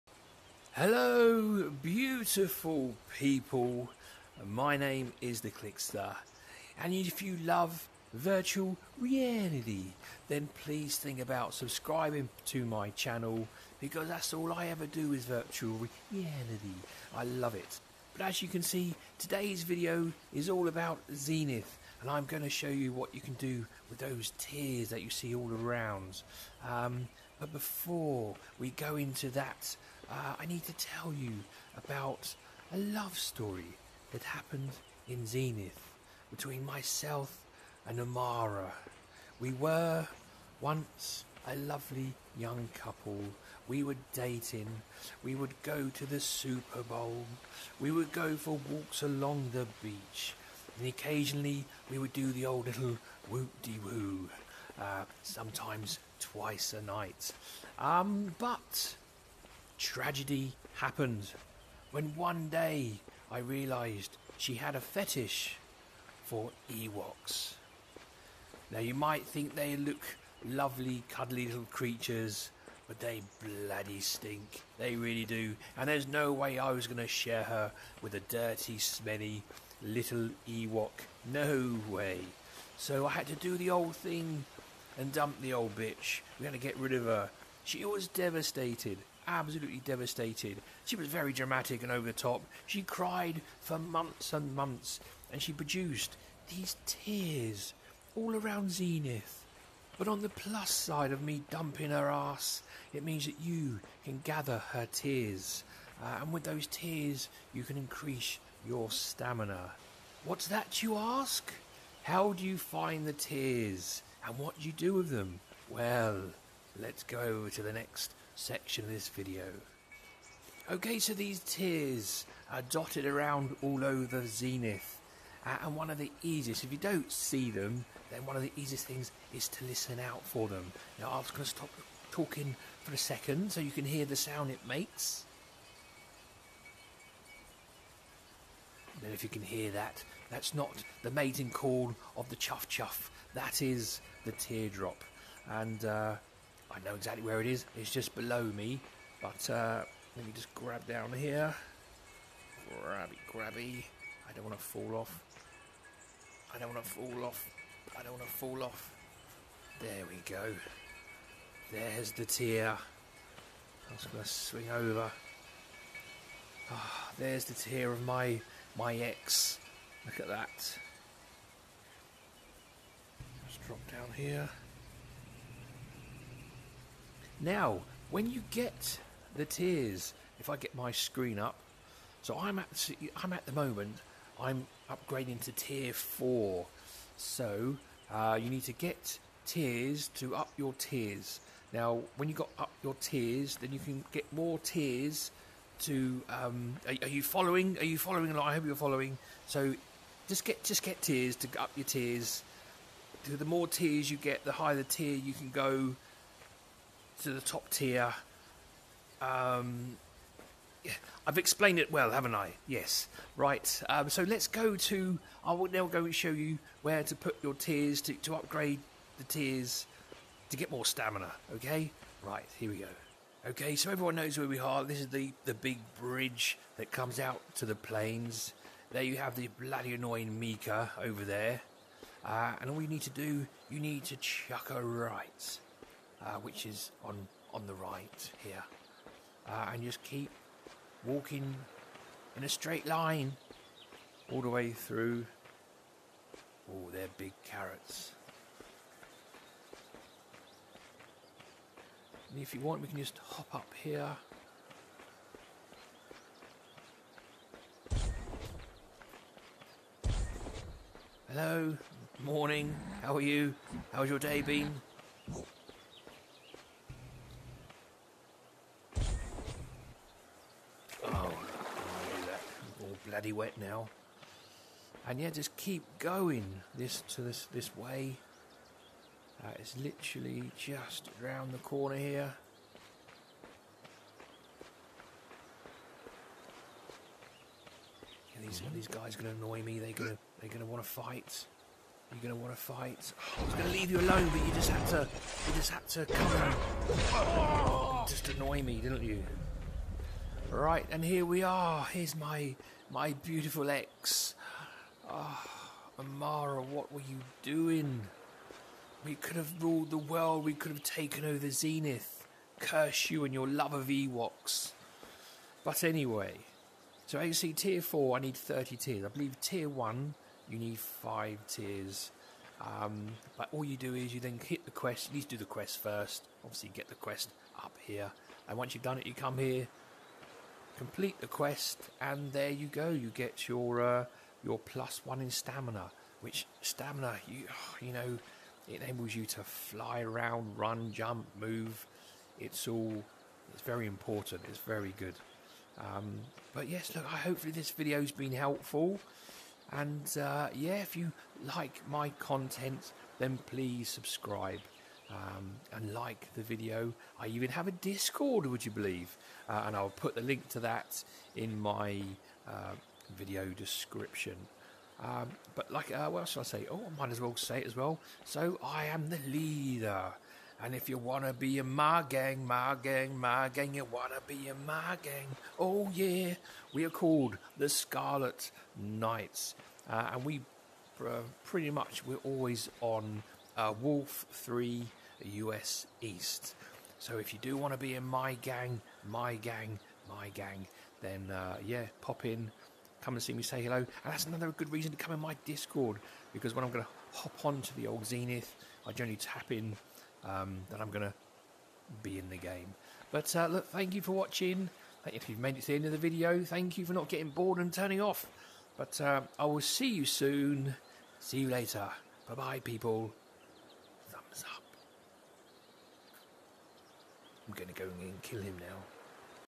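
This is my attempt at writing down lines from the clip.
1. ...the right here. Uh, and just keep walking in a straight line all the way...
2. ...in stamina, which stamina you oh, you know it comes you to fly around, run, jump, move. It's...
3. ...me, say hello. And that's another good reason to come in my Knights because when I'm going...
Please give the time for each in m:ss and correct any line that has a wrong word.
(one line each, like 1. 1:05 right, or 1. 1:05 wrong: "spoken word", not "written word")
1. 3:57 right
2. 5:35 wrong: "enables", not "comes"
3. 6:33 wrong: "Discord", not "Knights".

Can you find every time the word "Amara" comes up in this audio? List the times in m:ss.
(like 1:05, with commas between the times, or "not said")
0:37, 5:06.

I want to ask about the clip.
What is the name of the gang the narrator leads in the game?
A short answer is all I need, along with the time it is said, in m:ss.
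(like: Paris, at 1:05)
the Scarlet Knights, at 6:17.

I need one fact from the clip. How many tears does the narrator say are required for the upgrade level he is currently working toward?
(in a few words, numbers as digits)
30.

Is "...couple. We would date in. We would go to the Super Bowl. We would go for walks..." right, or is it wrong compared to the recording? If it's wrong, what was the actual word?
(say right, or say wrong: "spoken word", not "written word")
right.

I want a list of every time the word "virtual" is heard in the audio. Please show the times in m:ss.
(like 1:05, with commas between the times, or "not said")
0:08, 0:15.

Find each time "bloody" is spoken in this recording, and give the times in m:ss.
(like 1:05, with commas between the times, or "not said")
1:13, 3:49, 4:33.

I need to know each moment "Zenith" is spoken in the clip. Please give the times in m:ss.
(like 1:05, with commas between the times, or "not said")
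0:21, 0:35, 1:38, 2:04, 5:11, 6:38.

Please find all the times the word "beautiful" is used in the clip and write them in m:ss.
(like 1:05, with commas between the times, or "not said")
0:01, 5:03.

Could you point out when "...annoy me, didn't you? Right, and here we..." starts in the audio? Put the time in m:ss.
4:58.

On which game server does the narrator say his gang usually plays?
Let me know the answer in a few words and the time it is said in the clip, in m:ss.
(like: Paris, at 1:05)
Wolf Three US East, at 6:23.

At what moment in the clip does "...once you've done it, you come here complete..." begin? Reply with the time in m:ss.
5:28.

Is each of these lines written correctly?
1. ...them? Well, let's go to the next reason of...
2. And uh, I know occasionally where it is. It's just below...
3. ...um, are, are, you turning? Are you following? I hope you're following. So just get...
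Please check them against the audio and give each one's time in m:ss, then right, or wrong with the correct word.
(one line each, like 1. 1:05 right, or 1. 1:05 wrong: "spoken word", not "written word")
1. 1:55 wrong: "section", not "reason"
2. 2:25 wrong: "exactly", not "occasionally"
3. 3:16 wrong: "following", not "turning".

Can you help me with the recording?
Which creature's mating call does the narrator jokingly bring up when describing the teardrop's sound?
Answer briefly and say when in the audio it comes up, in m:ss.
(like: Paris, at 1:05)
the chuff chuff, at 2:22.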